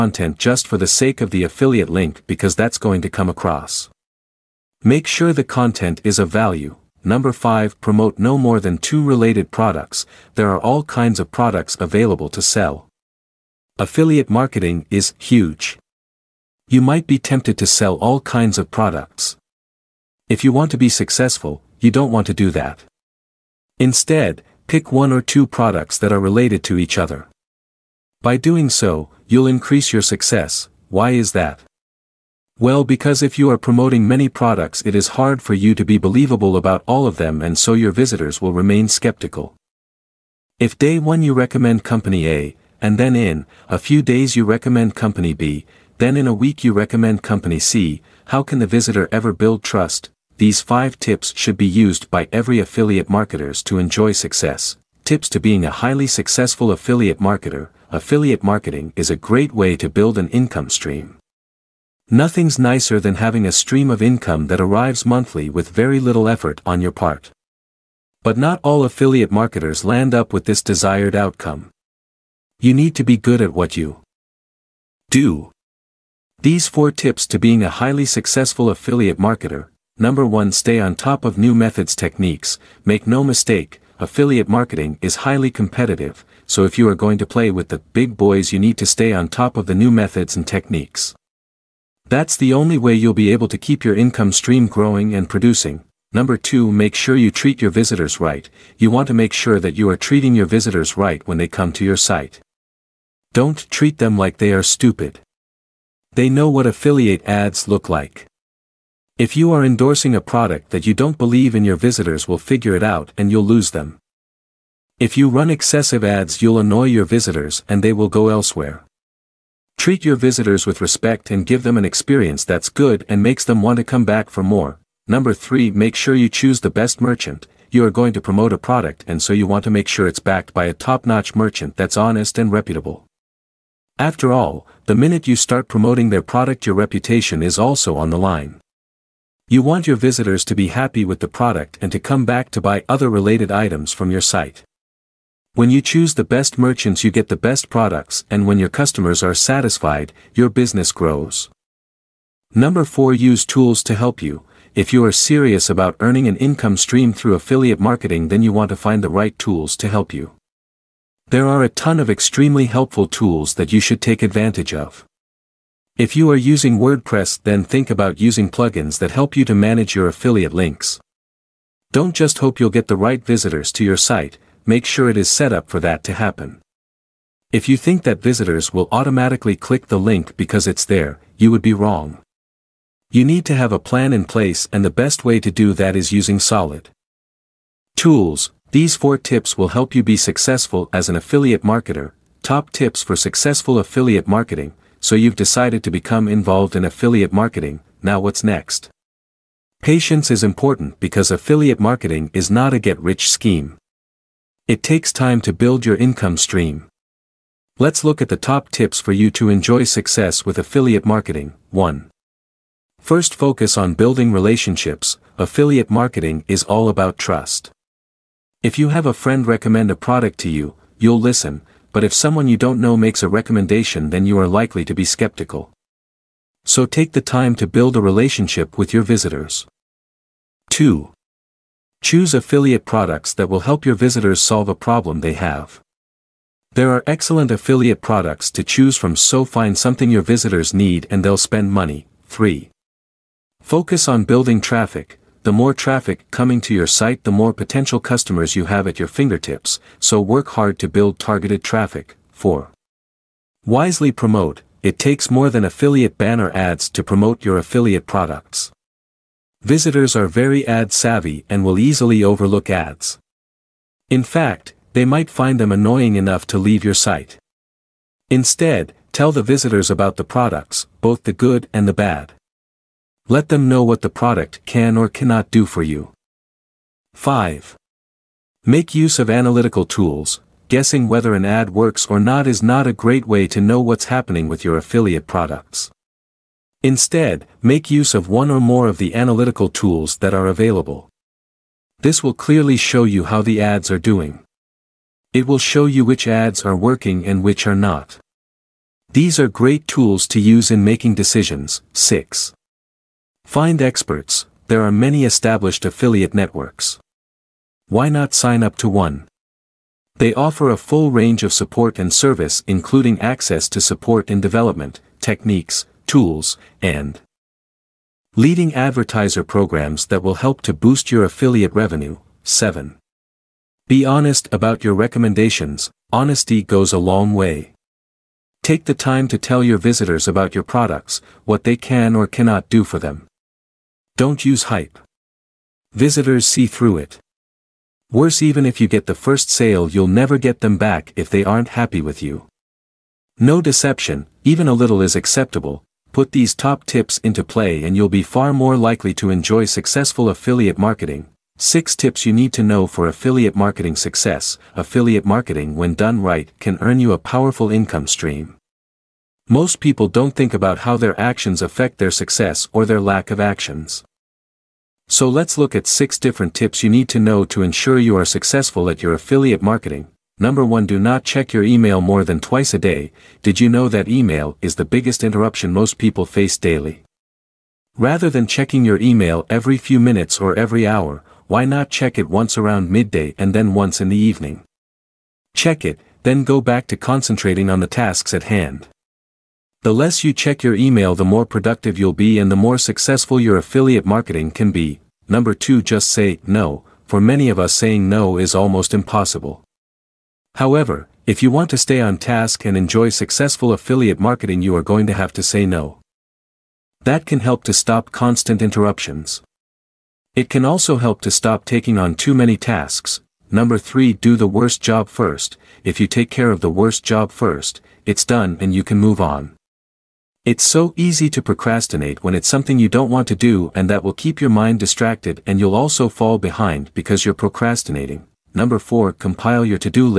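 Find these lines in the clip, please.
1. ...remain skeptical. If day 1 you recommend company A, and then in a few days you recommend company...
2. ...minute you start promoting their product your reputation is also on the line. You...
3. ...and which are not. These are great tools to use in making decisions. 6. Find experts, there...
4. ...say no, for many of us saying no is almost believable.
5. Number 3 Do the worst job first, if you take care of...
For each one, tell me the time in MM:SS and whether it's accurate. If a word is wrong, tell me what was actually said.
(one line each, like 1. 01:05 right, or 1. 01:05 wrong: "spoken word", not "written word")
1. 00:38 right
2. 02:14 right
3. 04:57 right
4. 06:36 wrong: "impossible", not "believable"
5. 06:53 right.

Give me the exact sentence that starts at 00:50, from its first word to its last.
These 5 tips should be used by every affiliate marketers to enjoy success.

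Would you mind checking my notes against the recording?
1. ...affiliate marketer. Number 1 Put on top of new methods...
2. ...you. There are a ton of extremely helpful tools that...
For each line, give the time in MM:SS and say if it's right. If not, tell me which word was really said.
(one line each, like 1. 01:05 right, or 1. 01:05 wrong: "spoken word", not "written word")
1. 01:18 wrong: "Stay", not "Put"
2. 02:40 right.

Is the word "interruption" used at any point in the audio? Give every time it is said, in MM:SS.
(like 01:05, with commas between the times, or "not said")
06:15, 06:48.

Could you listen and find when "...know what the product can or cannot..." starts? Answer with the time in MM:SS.
04:33.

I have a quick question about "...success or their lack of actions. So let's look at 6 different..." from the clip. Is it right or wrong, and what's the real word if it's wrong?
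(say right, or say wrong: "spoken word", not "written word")
right.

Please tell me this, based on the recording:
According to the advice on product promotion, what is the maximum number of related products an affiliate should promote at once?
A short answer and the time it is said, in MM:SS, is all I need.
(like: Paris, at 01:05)
2, at 00:08.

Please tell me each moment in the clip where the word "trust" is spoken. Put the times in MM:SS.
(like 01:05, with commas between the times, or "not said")
00:49, 03:37.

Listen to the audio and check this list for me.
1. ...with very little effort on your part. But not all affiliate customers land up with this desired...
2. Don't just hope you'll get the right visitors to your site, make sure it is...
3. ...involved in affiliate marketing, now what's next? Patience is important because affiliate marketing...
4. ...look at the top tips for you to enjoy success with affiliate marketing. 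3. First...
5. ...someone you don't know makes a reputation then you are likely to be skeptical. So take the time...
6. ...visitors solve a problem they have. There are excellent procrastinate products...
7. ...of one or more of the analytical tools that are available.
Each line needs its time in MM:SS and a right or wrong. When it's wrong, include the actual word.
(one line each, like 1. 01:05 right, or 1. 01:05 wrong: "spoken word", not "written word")
1. 01:05 wrong: "marketers", not "customers"
2. 02:51 right
3. 03:16 right
4. 03:28 wrong: "1", not "3"
5. 03:42 wrong: "recommendation", not "reputation"
6. 03:53 wrong: "affiliate", not "procrastinate"
7. 04:48 right.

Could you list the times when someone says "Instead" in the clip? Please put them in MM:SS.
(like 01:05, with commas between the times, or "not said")
00:23, 04:28, 04:46.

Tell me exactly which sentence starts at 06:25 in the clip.
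Check it, then go back to concentrating on the tasks at hand.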